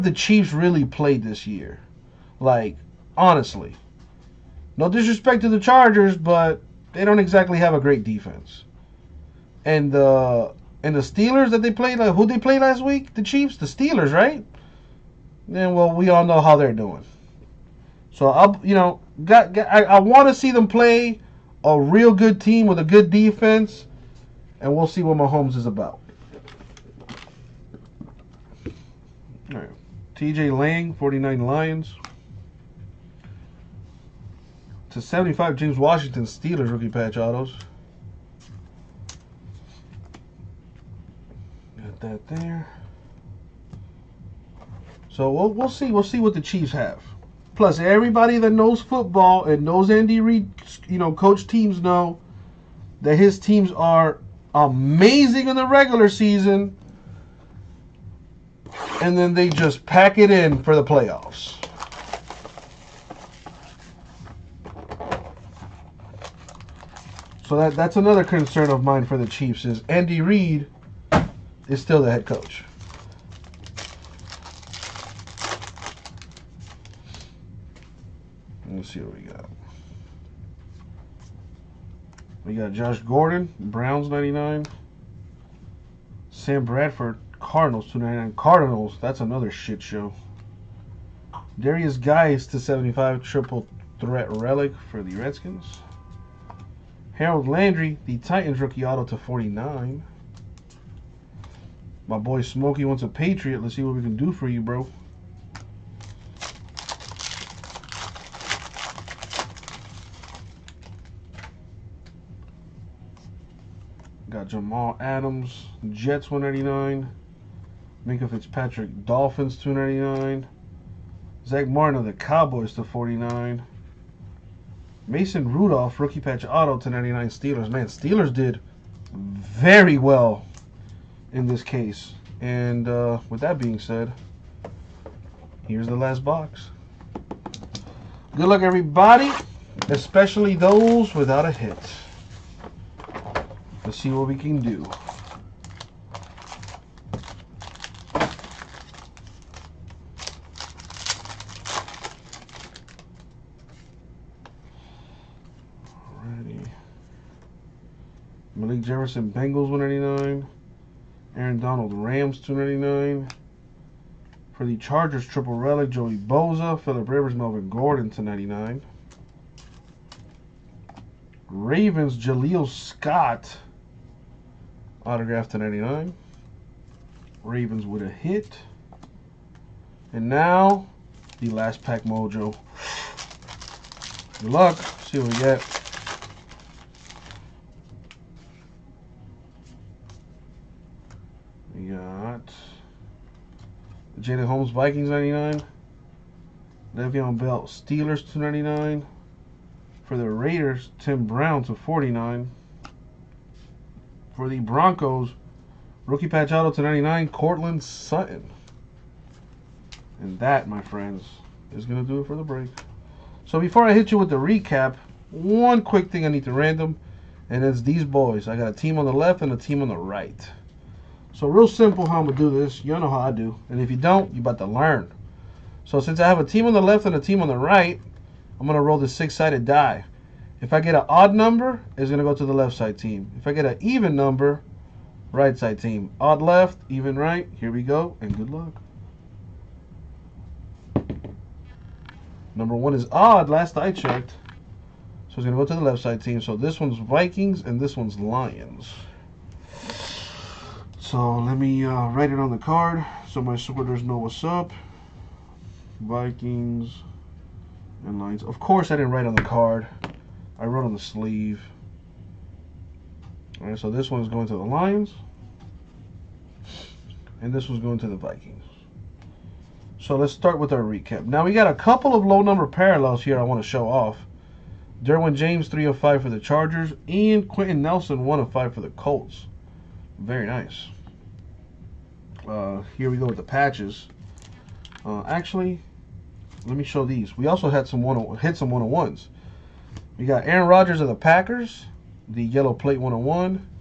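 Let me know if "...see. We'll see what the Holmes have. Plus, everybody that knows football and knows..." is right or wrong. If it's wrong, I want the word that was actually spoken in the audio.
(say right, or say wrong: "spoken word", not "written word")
wrong: "Chiefs", not "Holmes".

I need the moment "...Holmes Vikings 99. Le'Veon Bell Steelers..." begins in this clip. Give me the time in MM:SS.
03:14.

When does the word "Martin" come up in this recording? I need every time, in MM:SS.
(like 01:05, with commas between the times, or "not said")
02:01.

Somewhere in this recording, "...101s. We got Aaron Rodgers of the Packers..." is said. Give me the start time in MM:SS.
04:48.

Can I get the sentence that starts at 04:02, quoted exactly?
Number one is odd, last I checked.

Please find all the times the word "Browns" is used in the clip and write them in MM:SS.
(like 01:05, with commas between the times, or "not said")
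01:23, 03:21.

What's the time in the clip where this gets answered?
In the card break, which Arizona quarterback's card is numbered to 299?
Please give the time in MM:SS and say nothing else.
01:26.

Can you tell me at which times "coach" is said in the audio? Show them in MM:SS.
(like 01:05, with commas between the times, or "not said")
00:51, 01:12.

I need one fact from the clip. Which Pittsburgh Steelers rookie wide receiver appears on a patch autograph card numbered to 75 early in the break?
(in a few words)
James Washington.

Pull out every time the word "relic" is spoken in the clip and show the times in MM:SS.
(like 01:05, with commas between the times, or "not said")
01:34, 02:45.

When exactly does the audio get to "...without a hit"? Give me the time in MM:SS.
02:21.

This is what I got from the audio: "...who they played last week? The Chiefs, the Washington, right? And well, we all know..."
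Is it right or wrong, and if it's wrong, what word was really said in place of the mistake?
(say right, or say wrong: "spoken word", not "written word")
wrong: "Steelers", not "Washington".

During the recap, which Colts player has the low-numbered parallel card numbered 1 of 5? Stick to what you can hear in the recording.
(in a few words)
Quenton Nelson.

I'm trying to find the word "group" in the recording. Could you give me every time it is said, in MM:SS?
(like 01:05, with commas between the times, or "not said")
not said.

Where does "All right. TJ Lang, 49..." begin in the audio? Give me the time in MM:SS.
00:29.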